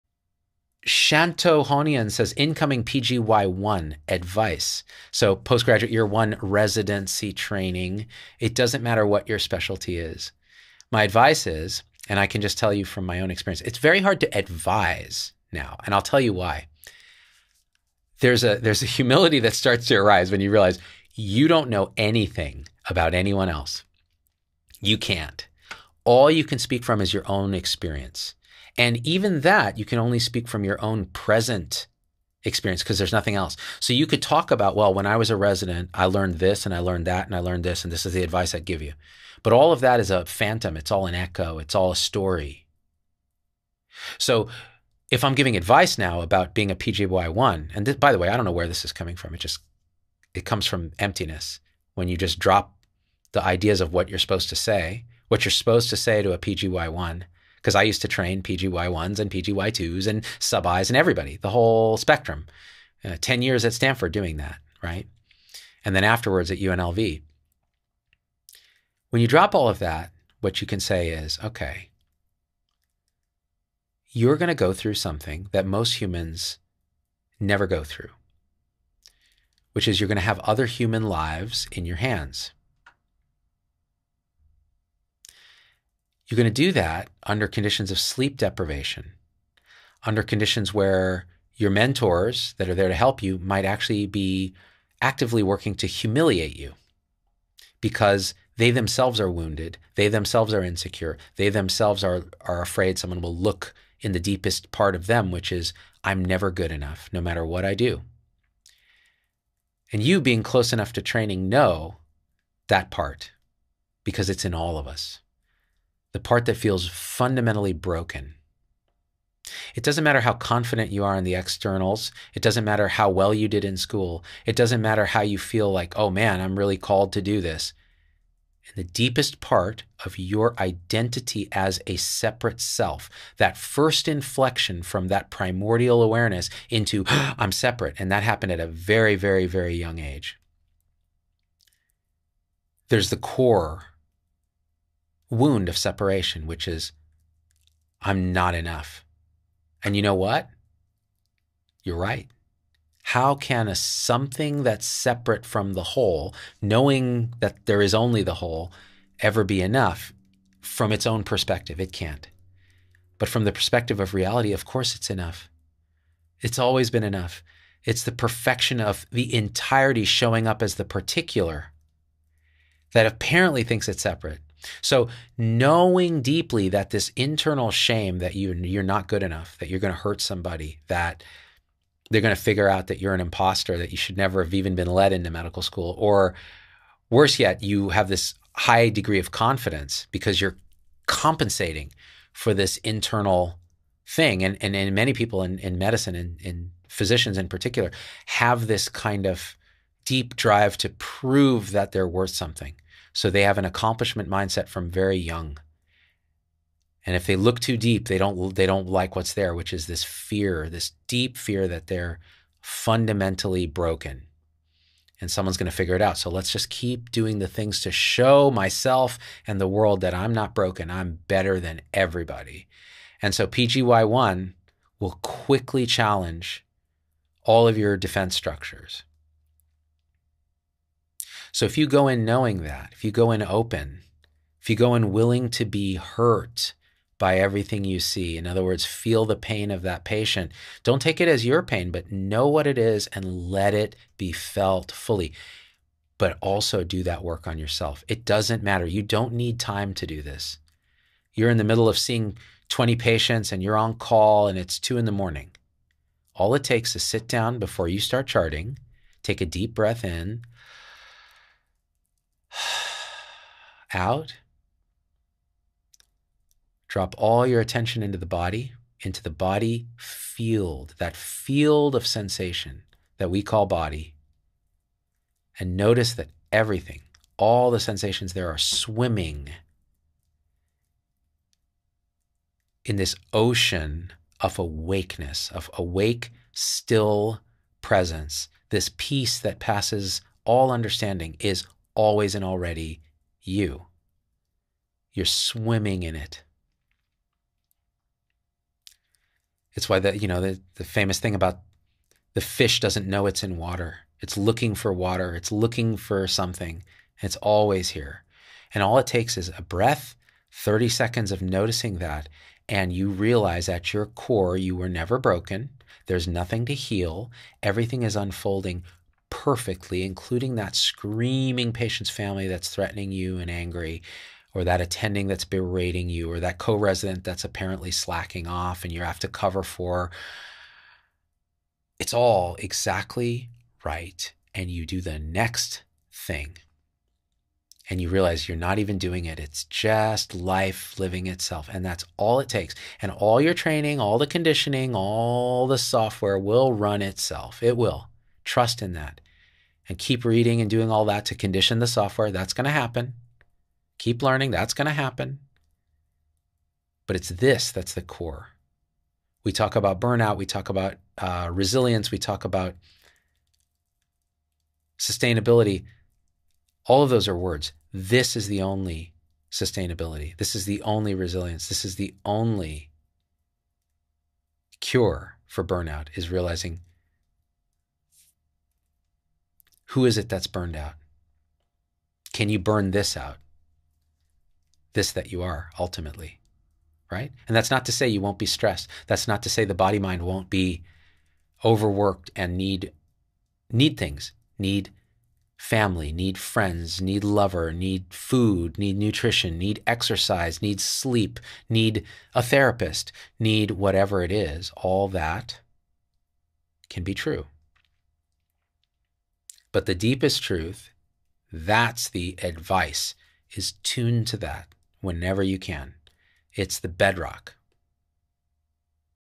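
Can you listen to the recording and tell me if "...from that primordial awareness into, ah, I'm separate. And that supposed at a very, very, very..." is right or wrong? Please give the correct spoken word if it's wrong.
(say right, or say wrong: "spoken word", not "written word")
wrong: "happened", not "supposed".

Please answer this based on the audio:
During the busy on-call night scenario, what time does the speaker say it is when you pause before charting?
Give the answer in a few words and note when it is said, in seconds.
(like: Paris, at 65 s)
2 a.m., at 254 s.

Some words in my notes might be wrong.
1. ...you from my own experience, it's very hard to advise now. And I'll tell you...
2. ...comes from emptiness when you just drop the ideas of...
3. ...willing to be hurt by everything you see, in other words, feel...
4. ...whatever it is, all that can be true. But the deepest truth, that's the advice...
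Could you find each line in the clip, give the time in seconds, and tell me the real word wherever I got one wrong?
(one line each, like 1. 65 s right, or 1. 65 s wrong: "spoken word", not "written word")
1. 12 s right
2. 50 s right
3. 235 s right
4. 403 s right.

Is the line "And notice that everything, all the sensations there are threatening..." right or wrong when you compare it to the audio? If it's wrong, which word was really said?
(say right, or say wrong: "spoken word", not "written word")
wrong: "swimming", not "threatening".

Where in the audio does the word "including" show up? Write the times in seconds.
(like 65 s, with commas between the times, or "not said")
320 s.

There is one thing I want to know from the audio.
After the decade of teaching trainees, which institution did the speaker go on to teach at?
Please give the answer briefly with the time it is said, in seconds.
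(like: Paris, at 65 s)
UNLV, at 66 s.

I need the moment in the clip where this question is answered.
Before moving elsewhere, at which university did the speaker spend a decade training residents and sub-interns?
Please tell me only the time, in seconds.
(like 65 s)
63 s.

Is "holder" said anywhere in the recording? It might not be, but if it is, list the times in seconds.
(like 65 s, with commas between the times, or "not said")
not said.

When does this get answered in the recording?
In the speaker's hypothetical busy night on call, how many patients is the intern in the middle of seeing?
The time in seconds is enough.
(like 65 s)
252 s.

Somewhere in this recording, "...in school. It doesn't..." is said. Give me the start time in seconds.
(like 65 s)
123 s.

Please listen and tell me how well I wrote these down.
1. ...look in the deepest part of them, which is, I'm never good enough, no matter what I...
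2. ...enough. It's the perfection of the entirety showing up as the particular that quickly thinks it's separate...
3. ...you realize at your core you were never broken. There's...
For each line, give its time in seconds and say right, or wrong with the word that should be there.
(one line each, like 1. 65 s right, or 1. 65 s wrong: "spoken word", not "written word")
1. 103 s right
2. 167 s wrong: "apparently", not "quickly"
3. 312 s right.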